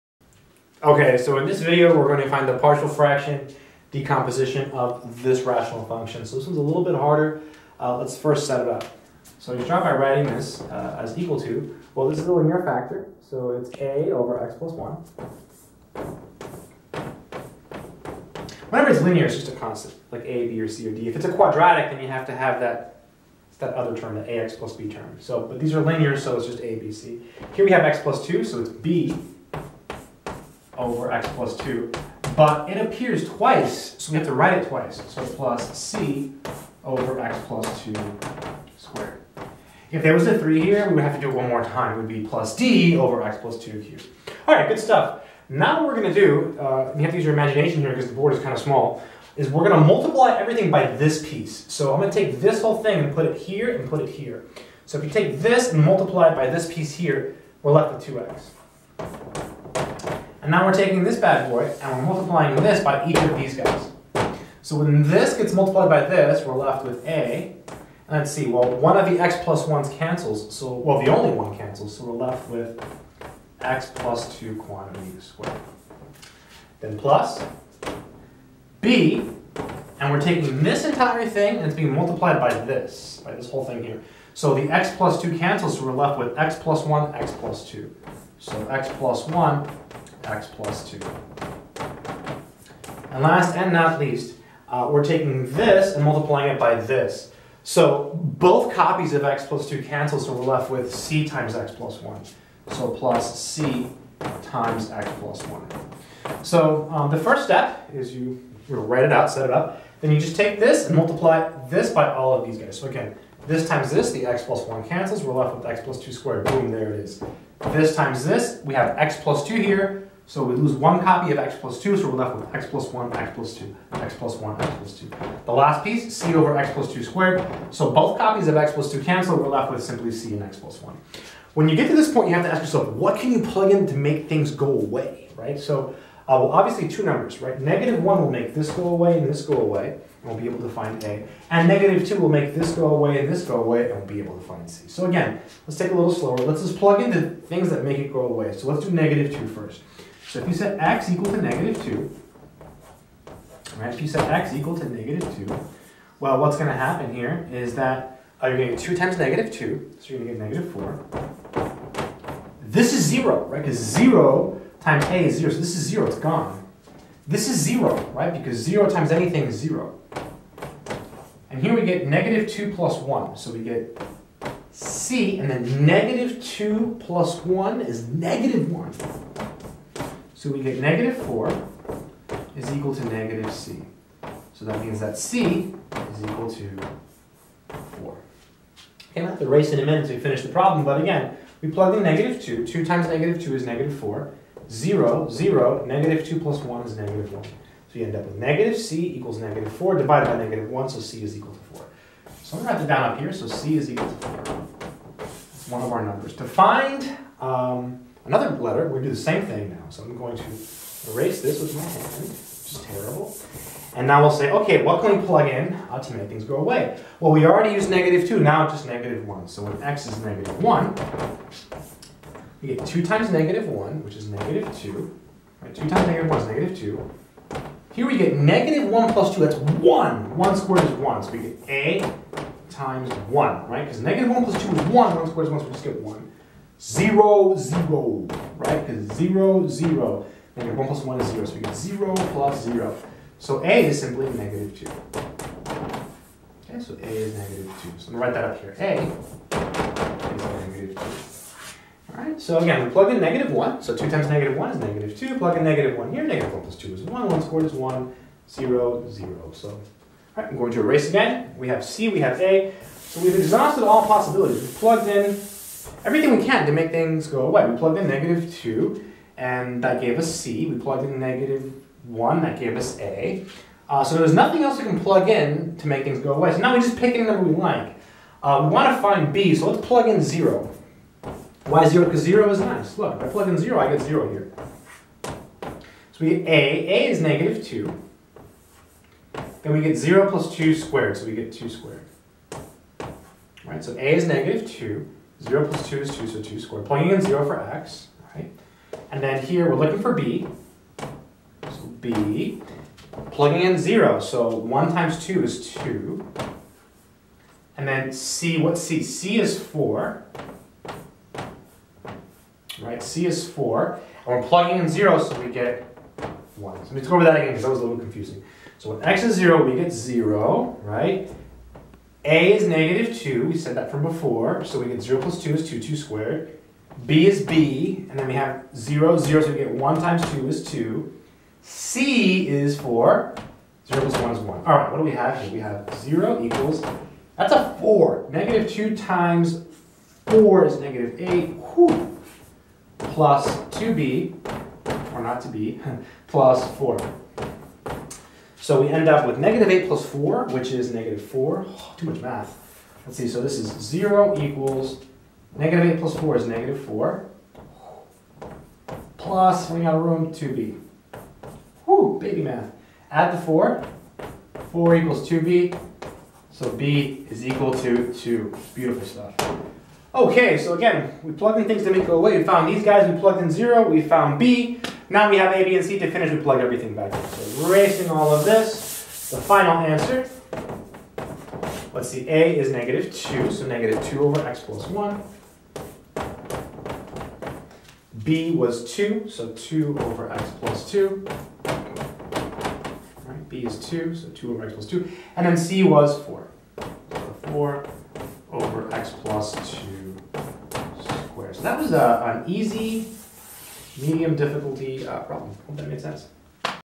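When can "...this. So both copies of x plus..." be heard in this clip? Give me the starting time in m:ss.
1:36.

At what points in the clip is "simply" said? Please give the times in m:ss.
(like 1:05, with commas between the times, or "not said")
2:09, 4:04.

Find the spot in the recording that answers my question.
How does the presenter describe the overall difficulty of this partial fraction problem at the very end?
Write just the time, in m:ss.
6:42.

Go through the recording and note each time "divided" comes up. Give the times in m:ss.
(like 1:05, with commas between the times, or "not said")
3:19.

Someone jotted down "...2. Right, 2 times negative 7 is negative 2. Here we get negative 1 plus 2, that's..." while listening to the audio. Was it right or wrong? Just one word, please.
wrong.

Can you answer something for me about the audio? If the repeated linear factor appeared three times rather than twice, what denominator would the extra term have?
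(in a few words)
x plus 2 cubed.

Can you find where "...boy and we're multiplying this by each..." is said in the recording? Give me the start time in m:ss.
1:01.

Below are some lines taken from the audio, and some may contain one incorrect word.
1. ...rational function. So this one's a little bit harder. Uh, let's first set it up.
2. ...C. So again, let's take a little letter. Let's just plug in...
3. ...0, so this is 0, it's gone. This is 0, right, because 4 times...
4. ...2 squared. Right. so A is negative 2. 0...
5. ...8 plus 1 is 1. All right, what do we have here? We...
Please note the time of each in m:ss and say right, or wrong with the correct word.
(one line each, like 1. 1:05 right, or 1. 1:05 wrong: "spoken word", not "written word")
1. 0:05 right
2. 2:24 wrong: "slower", not "letter"
3. 2:45 wrong: "0", not "4"
4. 4:51 right
5. 5:33 wrong: "0", not "8".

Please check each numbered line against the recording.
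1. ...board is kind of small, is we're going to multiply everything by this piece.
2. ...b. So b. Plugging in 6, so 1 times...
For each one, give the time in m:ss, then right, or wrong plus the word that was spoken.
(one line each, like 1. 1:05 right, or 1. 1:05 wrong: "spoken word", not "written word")
1. 0:48 right
2. 5:00 wrong: "0", not "6".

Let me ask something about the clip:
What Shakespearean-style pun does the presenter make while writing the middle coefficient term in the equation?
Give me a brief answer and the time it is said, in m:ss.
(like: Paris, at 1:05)
or not to be, at 5:45.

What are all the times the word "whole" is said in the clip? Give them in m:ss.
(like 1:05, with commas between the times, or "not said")
0:52, 1:23.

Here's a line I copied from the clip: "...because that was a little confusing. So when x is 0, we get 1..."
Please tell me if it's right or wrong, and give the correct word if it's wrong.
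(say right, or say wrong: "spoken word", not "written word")
wrong: "0", not "1".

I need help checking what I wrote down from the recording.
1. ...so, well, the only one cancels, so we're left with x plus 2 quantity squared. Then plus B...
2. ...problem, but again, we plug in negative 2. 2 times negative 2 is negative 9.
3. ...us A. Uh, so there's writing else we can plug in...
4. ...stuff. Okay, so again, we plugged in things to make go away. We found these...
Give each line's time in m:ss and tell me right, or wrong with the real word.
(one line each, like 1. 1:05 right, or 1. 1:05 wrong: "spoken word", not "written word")
1. 1:10 right
2. 3:10 wrong: "4", not "9"
3. 4:32 wrong: "nothing", not "writing"
4. 6:09 right.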